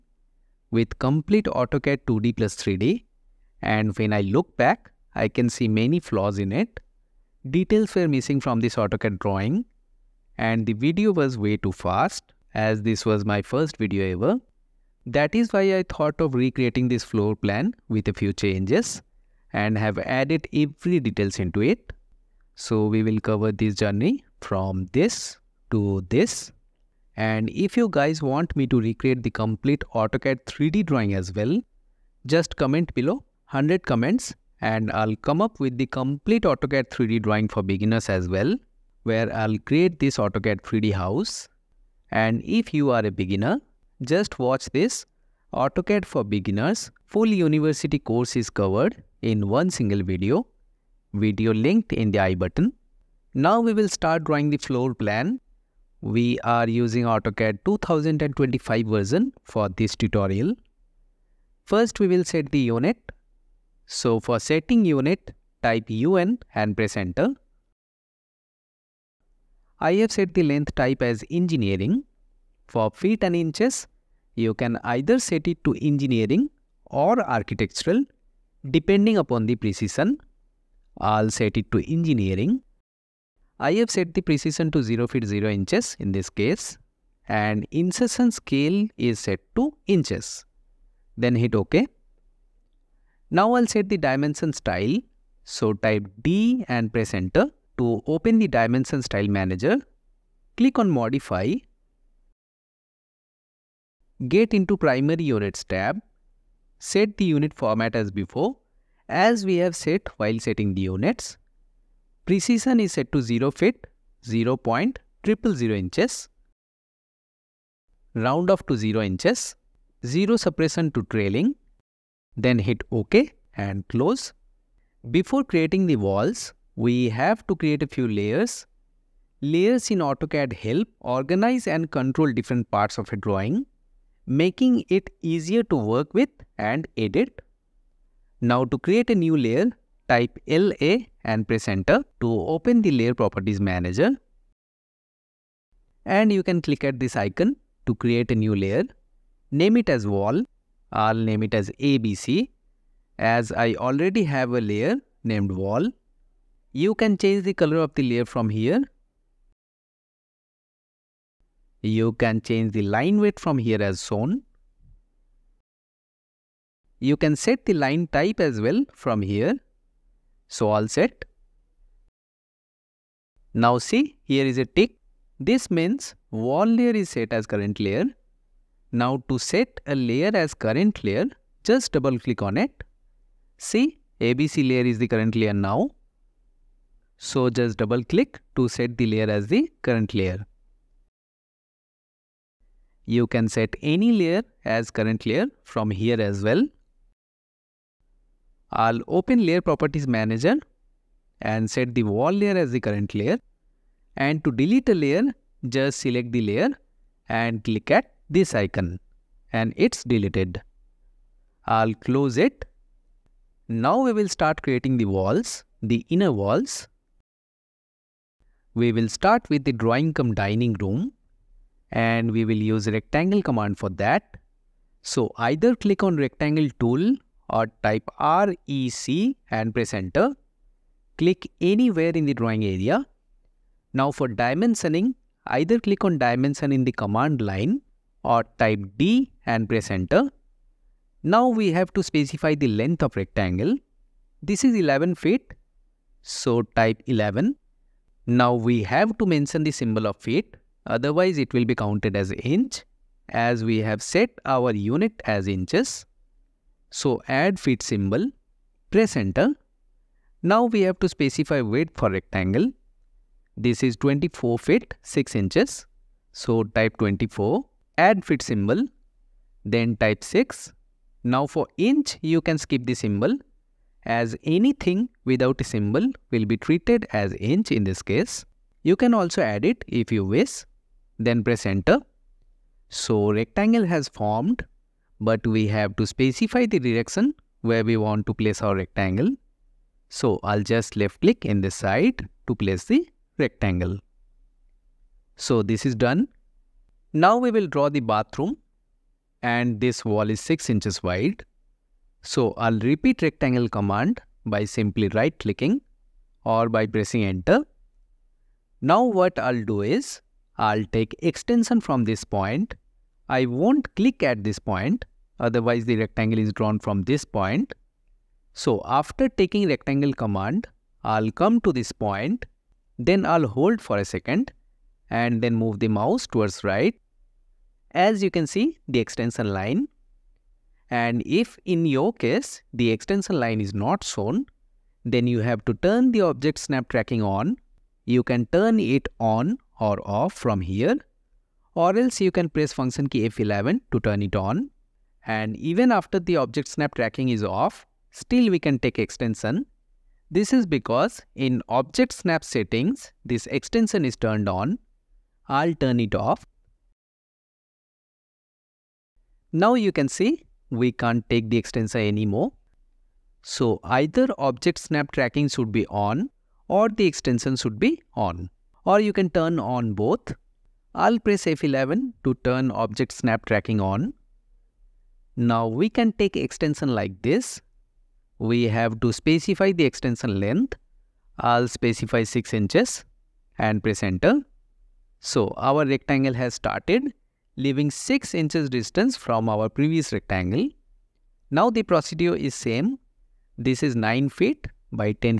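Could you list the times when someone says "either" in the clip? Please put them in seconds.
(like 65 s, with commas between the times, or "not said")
74 s, 225 s, 235 s, 363 s.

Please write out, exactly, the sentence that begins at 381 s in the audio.
I'll specify 6 inches and press enter.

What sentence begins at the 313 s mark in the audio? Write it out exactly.
I won't click at this point otherwise the rectangle is drawn from this point.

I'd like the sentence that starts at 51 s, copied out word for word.
Video linked in the I button.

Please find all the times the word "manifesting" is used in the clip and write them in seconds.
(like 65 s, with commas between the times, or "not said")
not said.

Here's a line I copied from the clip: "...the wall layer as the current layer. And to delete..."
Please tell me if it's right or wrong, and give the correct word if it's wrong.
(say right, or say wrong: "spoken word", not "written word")
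right.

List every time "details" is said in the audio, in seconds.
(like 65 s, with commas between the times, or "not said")
7 s, 21 s.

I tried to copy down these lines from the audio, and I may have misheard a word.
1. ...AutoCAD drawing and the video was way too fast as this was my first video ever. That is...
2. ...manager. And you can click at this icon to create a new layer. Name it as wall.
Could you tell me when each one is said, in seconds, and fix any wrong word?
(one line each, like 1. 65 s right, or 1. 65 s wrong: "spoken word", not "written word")
1. 8 s right
2. 143 s right.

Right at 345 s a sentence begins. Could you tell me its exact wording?
And even after the object snap tracking is off, still we can take extension.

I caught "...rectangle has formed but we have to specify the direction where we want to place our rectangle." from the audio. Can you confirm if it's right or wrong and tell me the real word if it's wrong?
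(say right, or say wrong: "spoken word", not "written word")
right.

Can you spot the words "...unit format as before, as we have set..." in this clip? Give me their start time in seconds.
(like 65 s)
107 s.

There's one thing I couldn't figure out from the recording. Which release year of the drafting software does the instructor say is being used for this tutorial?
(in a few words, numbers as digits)
2025.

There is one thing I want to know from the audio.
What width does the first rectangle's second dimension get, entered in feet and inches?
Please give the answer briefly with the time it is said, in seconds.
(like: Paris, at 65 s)
24 feet 6 inches, at 263 s.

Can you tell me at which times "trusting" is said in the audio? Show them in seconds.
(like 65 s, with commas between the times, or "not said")
not said.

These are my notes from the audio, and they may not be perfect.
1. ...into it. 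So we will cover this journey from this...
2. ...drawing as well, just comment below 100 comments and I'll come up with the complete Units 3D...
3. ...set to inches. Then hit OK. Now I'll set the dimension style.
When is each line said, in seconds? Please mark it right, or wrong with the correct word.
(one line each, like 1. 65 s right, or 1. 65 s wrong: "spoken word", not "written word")
1. 21 s right
2. 30 s wrong: "AutoCAD", not "Units"
3. 89 s right.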